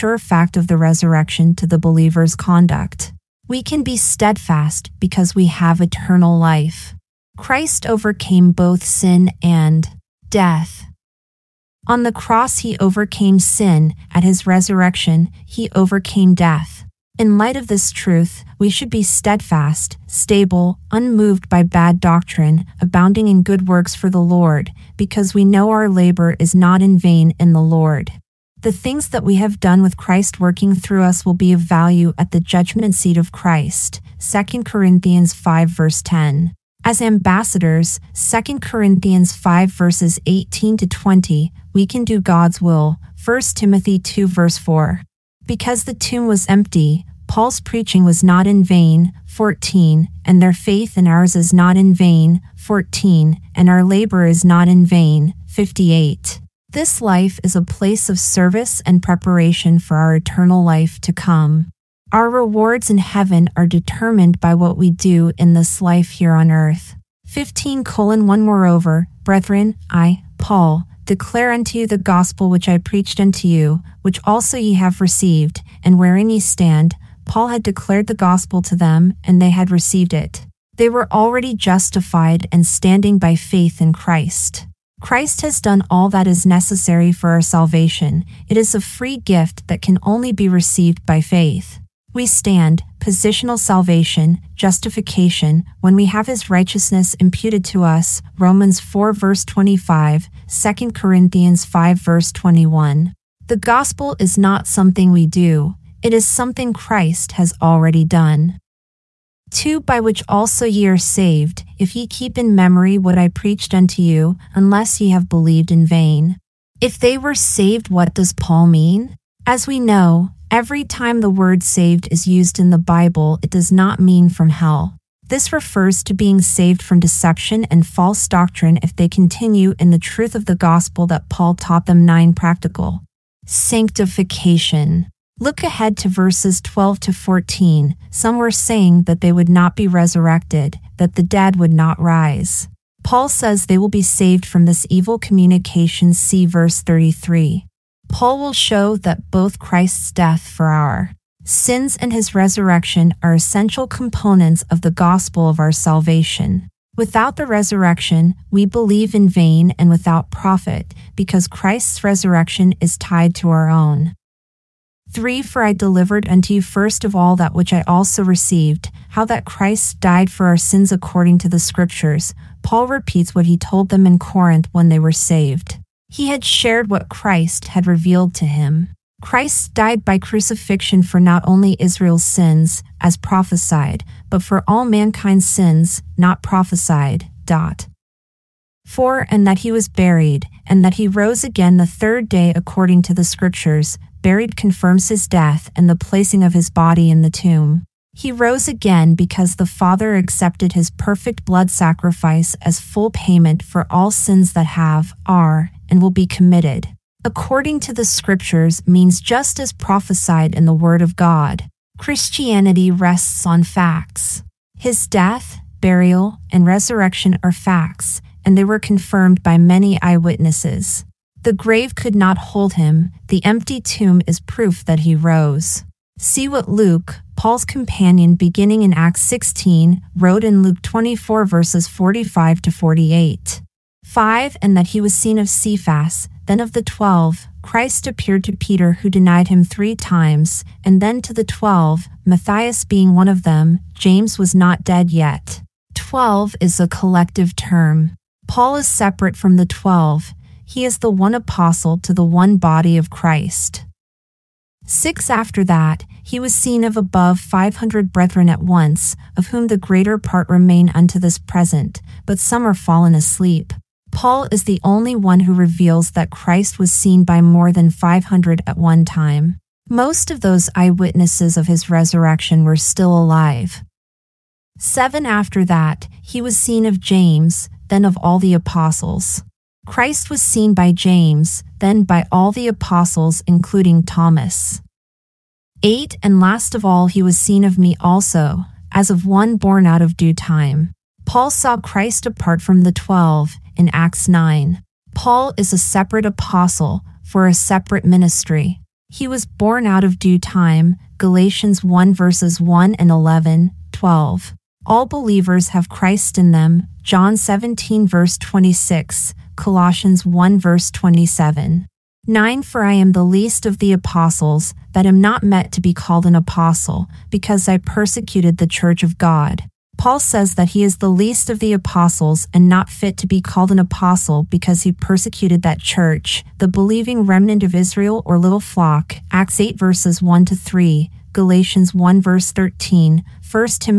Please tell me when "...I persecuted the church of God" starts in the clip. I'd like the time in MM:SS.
05:17.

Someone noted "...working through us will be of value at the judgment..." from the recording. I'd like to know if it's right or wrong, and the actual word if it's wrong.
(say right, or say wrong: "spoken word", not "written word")
right.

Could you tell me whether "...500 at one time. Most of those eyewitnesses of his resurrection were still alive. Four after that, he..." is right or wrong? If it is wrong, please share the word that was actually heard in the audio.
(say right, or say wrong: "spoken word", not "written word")
wrong: "Seven", not "Four".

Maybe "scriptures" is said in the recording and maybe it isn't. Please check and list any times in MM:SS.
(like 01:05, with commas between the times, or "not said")
02:51, 03:13, 03:28.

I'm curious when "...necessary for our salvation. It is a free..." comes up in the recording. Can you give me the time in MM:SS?
01:26.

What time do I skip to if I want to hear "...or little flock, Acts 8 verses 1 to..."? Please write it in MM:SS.
05:28.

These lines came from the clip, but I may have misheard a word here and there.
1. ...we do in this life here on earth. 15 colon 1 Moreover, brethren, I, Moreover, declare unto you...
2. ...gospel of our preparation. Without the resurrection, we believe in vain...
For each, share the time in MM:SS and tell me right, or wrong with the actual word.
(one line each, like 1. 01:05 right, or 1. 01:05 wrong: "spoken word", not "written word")
1. 01:04 wrong: "Paul", not "Moreover"
2. 02:34 wrong: "salvation", not "preparation".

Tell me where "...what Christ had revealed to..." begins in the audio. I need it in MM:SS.
02:56.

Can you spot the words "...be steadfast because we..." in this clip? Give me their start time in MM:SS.
00:03.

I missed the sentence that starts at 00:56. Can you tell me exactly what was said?
This life is a place of service and preparation for our eternal life to come.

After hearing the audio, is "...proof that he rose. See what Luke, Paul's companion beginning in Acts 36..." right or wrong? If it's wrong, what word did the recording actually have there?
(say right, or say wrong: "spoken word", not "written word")
wrong: "16", not "36".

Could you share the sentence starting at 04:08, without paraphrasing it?
Paul is separate from the twelve.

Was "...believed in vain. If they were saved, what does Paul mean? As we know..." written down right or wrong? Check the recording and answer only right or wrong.
right.